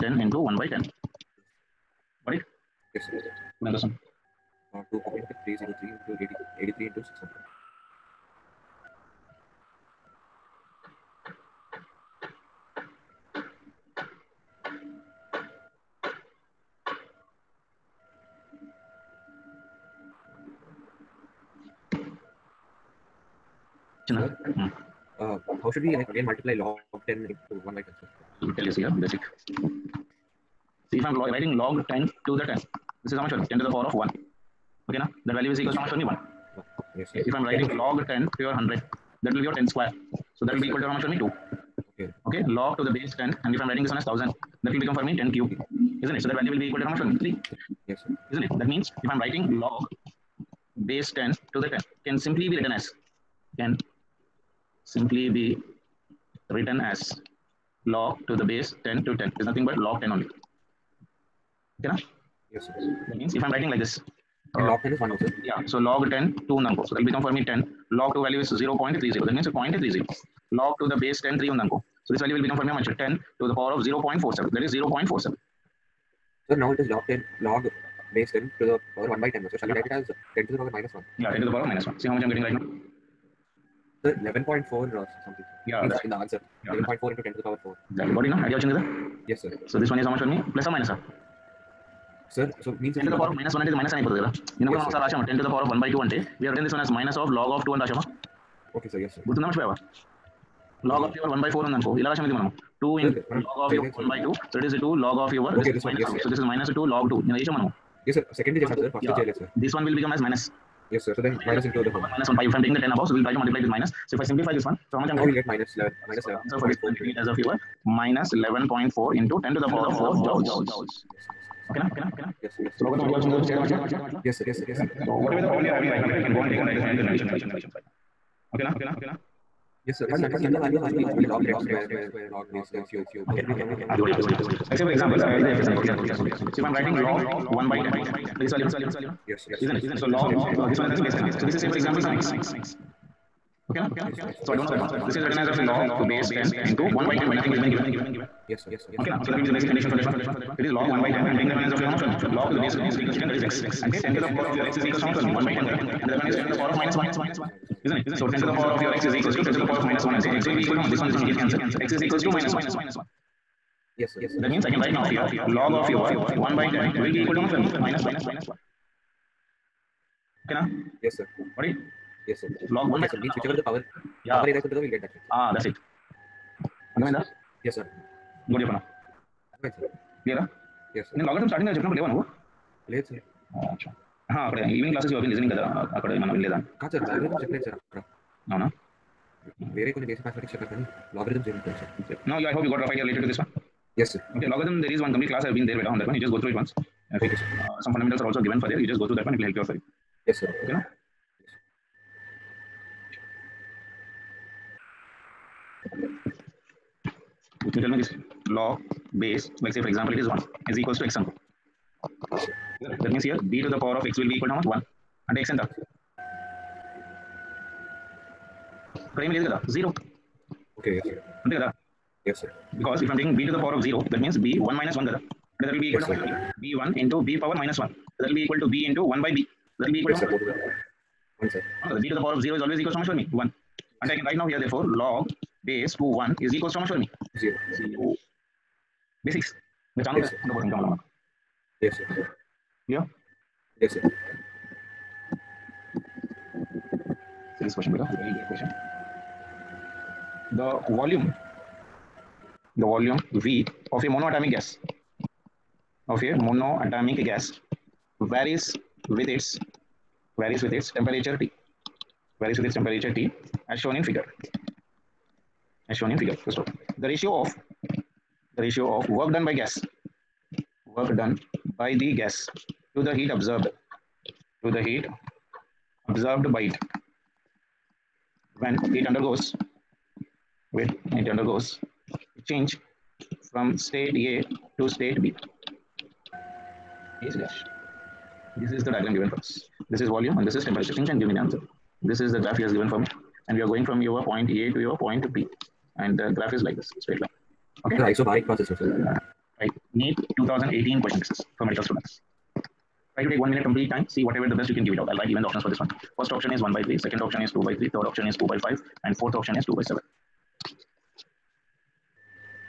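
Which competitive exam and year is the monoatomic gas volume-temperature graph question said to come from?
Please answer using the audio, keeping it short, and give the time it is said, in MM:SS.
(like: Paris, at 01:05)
NEET 2018, at 04:59.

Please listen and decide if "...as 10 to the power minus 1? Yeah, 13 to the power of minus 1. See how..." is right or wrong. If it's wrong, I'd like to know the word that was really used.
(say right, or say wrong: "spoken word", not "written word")
wrong: "10", not "13".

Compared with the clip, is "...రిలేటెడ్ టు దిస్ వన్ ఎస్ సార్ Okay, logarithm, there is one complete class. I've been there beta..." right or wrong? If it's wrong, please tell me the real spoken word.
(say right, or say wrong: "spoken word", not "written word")
right.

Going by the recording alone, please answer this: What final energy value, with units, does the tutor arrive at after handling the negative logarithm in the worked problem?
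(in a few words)
-11.4 × 10^4 joules.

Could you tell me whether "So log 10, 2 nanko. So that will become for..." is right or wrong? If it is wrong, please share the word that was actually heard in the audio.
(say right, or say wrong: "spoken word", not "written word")
right.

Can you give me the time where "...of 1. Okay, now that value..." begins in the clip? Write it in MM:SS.
00:33.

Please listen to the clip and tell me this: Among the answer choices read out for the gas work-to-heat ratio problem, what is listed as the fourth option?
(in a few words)
2/7.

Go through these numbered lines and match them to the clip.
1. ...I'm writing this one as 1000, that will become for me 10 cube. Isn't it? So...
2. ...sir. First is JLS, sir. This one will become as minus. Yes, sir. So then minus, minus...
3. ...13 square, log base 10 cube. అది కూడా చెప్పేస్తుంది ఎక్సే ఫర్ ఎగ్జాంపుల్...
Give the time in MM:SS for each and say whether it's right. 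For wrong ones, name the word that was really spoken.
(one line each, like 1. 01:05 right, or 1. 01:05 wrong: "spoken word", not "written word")
1. 00:43 right
2. 01:48 right
3. 02:11 wrong: "10", not "13".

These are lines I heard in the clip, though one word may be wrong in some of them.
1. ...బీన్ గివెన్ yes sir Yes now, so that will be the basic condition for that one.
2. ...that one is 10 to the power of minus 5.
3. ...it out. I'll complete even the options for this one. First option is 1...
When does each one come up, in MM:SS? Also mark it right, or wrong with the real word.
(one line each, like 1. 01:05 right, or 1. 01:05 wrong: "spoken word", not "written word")
1. 02:27 wrong: "Okay", not "Yes"
2. 02:36 wrong: "1", not "5"
3. 05:04 wrong: "write", not "complete".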